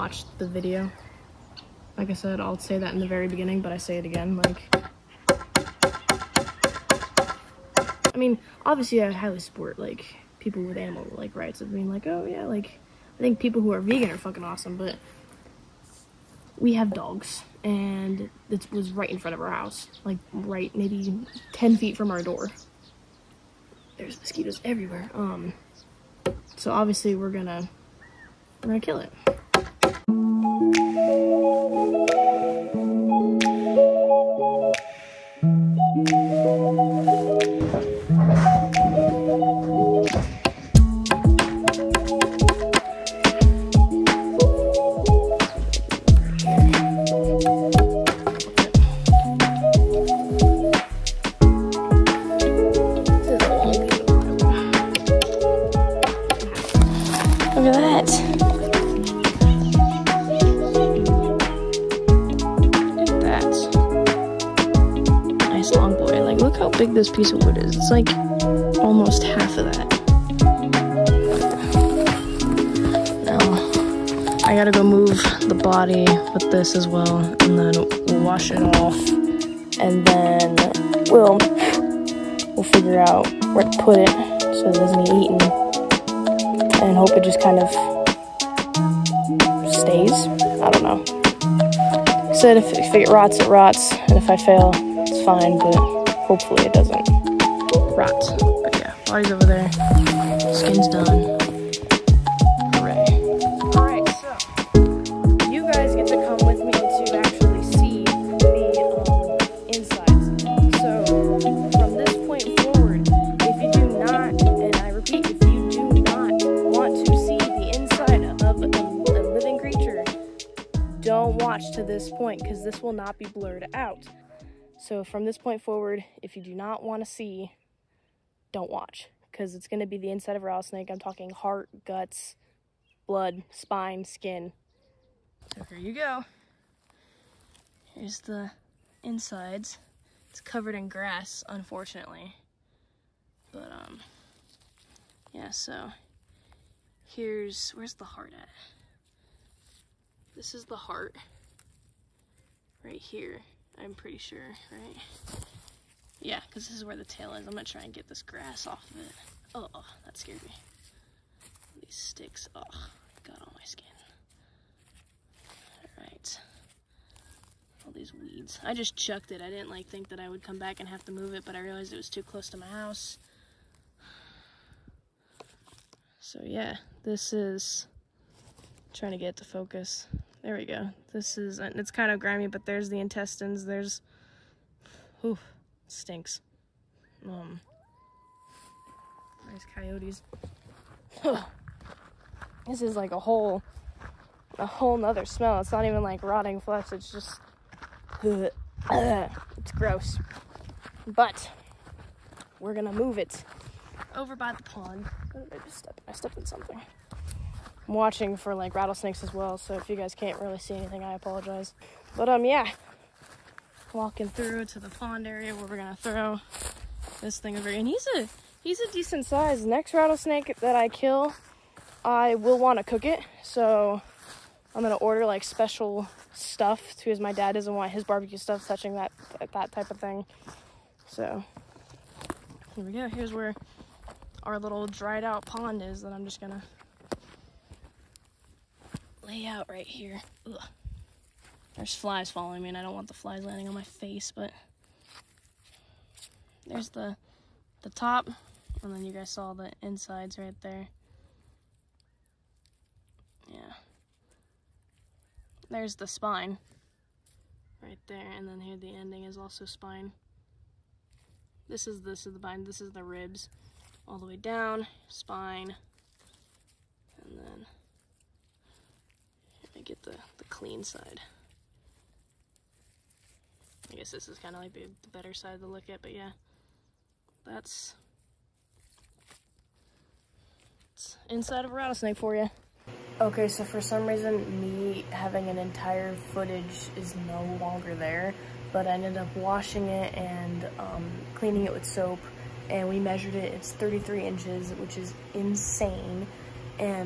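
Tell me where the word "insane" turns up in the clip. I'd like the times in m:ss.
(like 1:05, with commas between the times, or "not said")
4:55.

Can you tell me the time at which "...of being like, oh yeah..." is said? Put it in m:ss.
0:11.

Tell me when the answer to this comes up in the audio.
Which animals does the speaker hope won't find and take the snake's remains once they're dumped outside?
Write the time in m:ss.
3:09.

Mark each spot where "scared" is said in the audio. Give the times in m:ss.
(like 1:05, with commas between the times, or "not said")
2:40.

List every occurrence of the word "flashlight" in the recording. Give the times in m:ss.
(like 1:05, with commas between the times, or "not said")
not said.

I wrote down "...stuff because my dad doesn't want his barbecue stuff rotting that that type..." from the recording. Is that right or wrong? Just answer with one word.
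wrong.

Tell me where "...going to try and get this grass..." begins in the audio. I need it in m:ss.
2:37.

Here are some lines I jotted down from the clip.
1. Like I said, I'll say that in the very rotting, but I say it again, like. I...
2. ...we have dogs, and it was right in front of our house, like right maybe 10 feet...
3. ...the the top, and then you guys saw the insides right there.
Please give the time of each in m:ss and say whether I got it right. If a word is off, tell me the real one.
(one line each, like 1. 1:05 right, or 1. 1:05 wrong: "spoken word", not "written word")
1. 0:01 wrong: "beginning", not "rotting"
2. 0:16 right
3. 4:06 right.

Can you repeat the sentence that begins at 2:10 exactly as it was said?
I'm talking heart, guts, blood, spine, skin.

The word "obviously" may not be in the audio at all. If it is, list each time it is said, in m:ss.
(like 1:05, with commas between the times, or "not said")
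0:08, 0:26.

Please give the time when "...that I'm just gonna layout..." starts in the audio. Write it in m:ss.
3:56.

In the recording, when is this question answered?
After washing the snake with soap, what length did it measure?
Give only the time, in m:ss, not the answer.
4:53.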